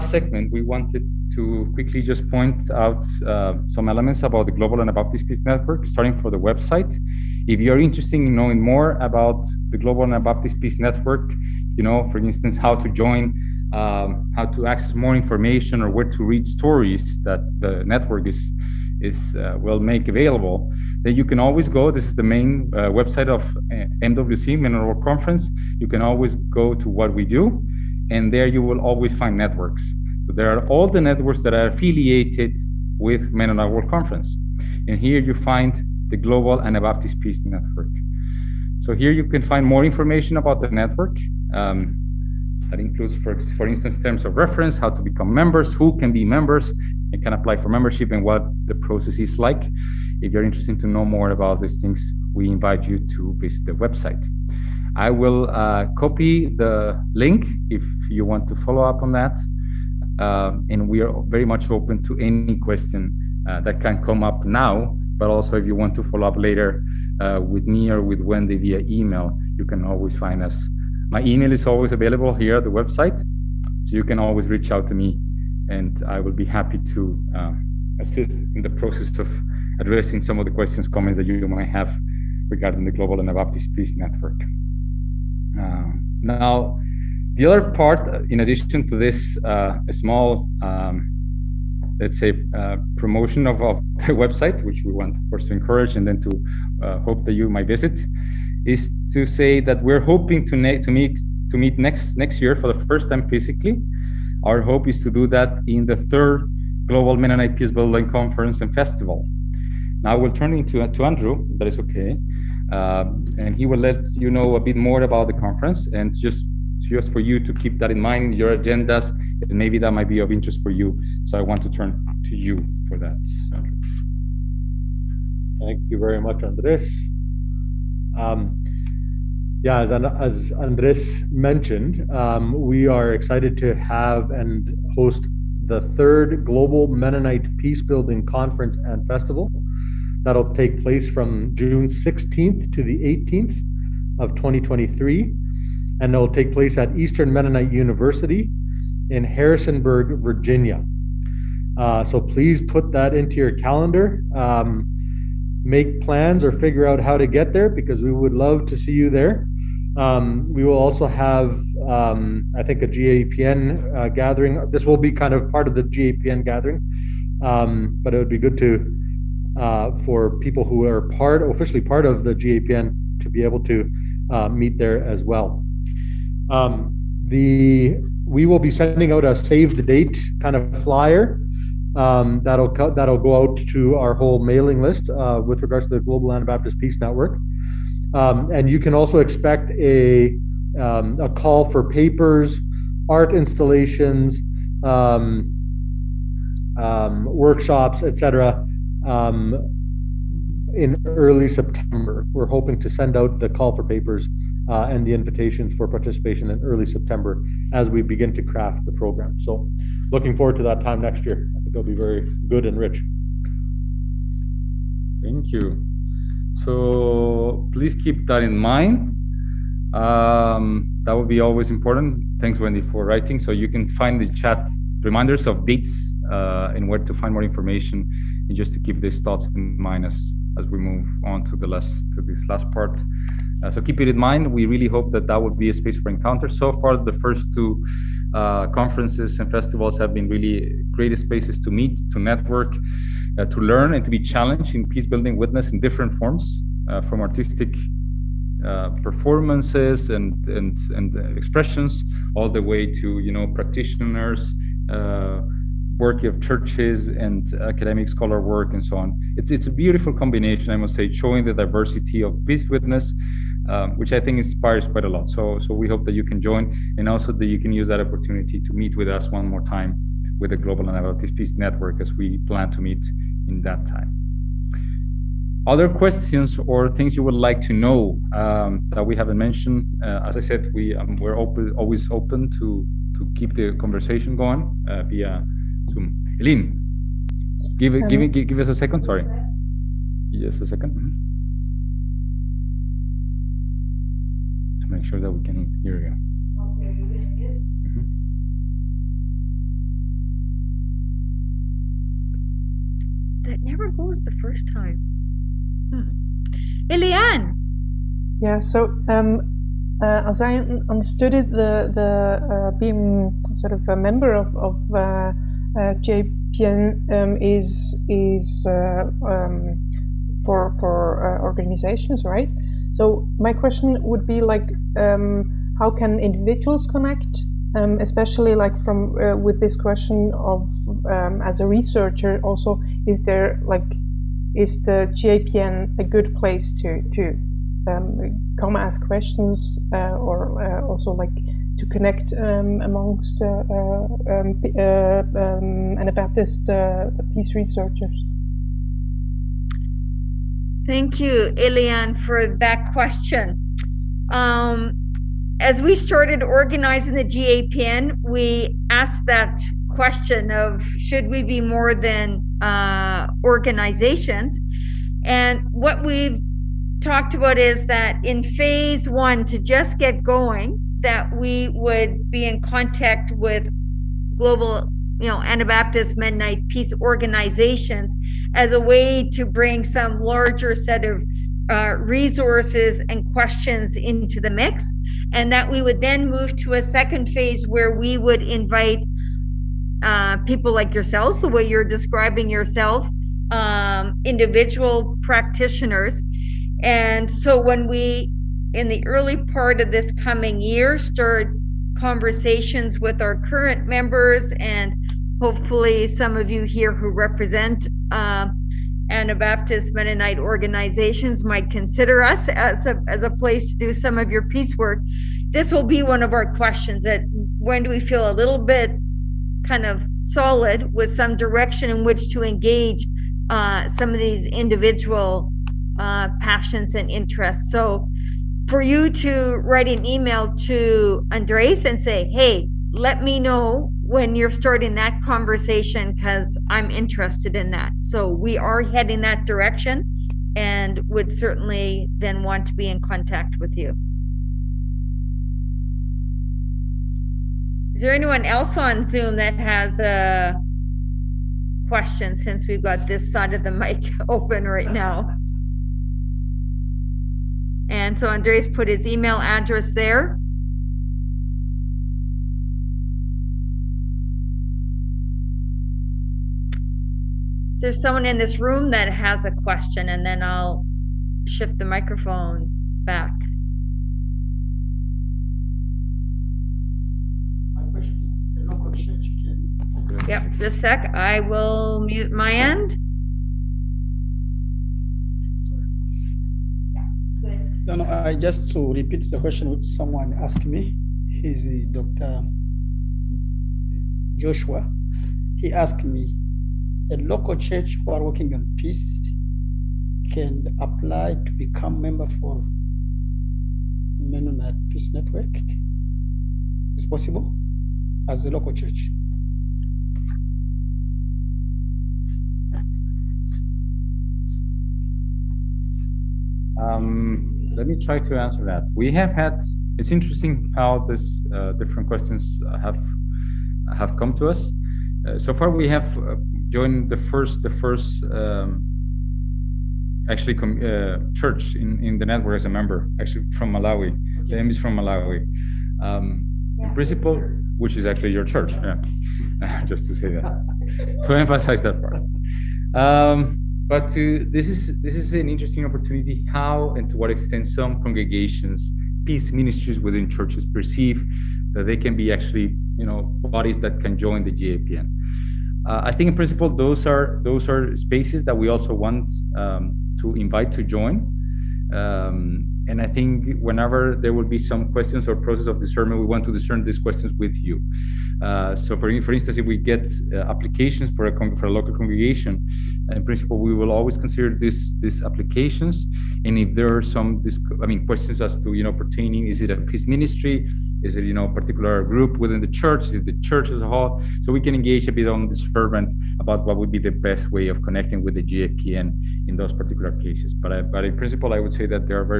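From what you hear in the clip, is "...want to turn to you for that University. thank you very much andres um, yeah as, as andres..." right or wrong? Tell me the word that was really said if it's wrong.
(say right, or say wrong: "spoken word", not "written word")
wrong: "Andrew", not "University".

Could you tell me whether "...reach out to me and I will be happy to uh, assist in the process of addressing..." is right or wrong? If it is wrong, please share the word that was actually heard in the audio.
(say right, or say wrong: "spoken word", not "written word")
right.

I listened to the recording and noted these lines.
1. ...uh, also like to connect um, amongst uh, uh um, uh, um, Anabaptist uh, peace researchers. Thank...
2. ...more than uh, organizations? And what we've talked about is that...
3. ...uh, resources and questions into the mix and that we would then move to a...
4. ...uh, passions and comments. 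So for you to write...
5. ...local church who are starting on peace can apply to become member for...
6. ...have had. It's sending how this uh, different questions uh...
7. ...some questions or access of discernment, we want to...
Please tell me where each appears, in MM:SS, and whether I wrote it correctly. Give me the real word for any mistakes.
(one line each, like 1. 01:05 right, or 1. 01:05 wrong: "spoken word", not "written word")
1. 05:40 right
2. 06:01 right
3. 06:21 right
4. 07:05 wrong: "interests", not "comments"
5. 08:17 wrong: "working", not "starting"
6. 08:39 wrong: "interesting", not "sending"
7. 09:24 wrong: "process", not "access".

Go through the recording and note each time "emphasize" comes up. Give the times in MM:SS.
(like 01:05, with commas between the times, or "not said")
09:01.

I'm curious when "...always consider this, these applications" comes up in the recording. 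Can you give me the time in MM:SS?
09:33.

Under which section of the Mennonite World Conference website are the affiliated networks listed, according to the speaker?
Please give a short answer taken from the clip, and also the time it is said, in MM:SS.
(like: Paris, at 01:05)
What we do, at 00:26.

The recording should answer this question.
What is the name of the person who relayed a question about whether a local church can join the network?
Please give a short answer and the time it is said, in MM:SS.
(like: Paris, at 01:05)
Dr. Joshua, at 08:11.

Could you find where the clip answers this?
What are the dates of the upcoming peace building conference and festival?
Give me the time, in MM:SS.
02:21.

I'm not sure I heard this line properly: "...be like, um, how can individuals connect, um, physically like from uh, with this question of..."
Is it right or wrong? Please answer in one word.
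wrong.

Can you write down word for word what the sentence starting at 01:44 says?
Our hope is to do that in the third Global Mennonite Peace Building Conference and Festival.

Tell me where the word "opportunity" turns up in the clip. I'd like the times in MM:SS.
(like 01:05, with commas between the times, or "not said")
04:27, 09:05.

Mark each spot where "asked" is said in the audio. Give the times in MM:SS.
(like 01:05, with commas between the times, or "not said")
05:58, 08:10, 08:15.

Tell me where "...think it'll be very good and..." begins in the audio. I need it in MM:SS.
03:31.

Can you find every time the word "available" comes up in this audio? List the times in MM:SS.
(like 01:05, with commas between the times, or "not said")
00:20, 01:11.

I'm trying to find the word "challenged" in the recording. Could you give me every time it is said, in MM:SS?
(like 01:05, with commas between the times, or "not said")
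04:04.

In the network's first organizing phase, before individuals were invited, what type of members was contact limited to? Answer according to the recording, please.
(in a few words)
Peace organizations.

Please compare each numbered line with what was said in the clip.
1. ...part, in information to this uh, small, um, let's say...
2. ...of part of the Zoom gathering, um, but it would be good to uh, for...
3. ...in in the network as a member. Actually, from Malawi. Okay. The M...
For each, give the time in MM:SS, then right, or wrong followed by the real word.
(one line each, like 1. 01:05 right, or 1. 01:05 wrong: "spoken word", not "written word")
1. 01:27 wrong: "addition", not "information"
2. 02:45 wrong: "GAPN", not "Zoom"
3. 08:51 right.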